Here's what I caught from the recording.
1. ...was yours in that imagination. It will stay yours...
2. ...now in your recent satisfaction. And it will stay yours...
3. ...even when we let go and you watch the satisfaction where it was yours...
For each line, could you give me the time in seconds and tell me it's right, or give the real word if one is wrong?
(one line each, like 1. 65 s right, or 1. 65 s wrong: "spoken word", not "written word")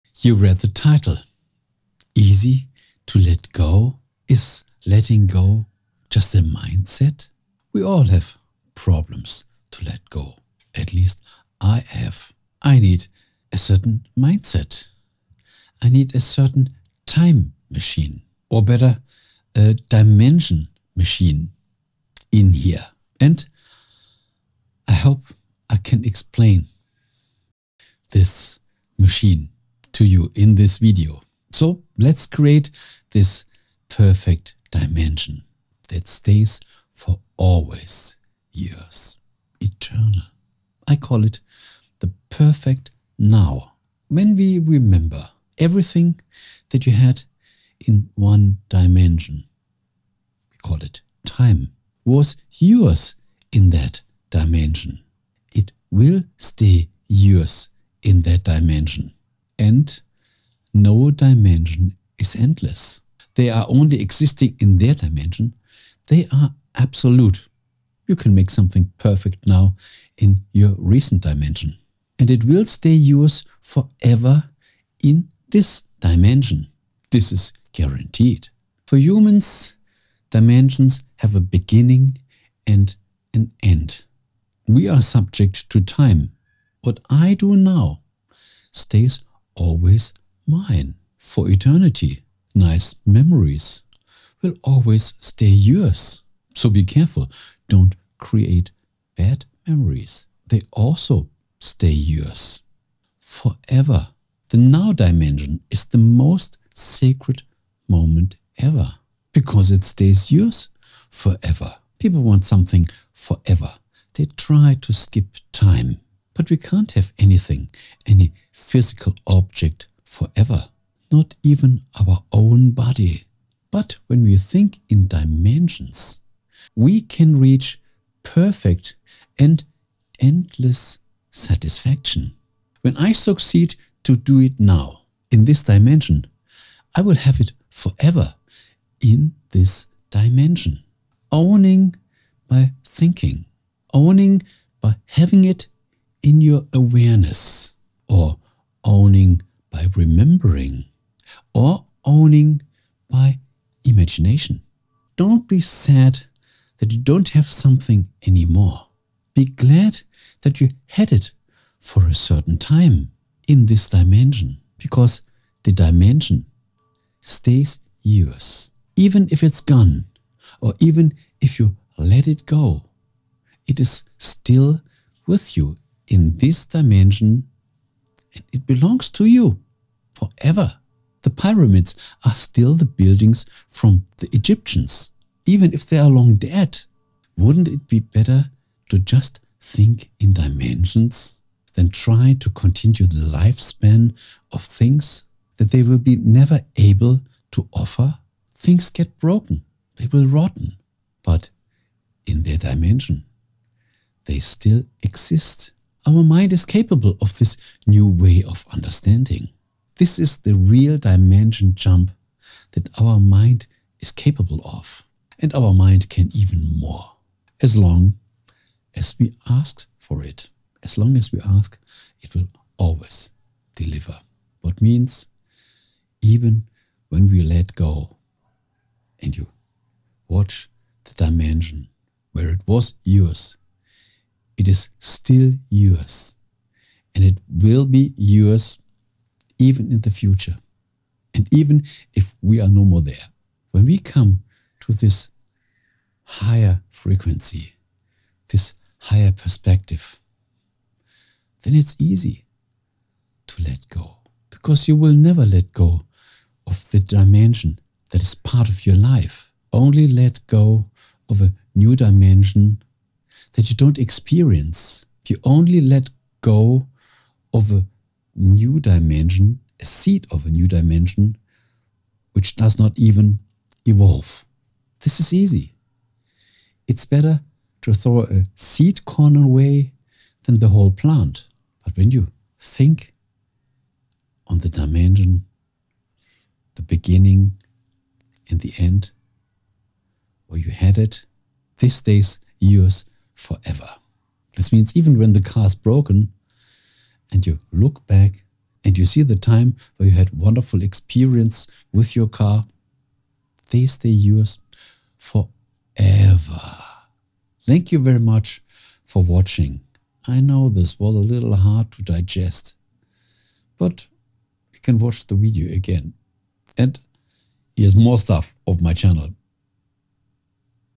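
1. 52 s wrong: "dimension", not "imagination"
2. 69 s wrong: "dimension", not "satisfaction"
3. 226 s wrong: "dimension", not "satisfaction".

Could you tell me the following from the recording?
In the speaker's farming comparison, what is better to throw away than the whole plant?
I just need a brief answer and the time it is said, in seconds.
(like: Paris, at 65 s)
A seed corn, at 278 s.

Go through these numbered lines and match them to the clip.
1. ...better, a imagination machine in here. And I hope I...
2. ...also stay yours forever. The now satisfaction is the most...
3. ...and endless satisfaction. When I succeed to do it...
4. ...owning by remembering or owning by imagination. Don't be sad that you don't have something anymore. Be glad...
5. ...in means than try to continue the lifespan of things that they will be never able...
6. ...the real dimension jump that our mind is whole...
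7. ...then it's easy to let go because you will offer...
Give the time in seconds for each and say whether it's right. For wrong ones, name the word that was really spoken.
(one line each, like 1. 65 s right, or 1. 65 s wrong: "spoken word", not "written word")
1. 18 s wrong: "dimension", not "imagination"
2. 100 s wrong: "dimension", not "satisfaction"
3. 129 s right
4. 148 s right
5. 190 s wrong: "dimensions", not "means"
6. 210 s wrong: "capable", not "whole"
7. 251 s wrong: "never", not "offer".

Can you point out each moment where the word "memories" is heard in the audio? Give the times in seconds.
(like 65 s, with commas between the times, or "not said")
93 s, 99 s.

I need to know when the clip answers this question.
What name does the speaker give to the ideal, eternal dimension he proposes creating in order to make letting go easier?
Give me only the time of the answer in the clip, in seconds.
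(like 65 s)
41 s.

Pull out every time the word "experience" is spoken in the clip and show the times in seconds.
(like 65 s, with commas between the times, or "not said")
263 s, 300 s.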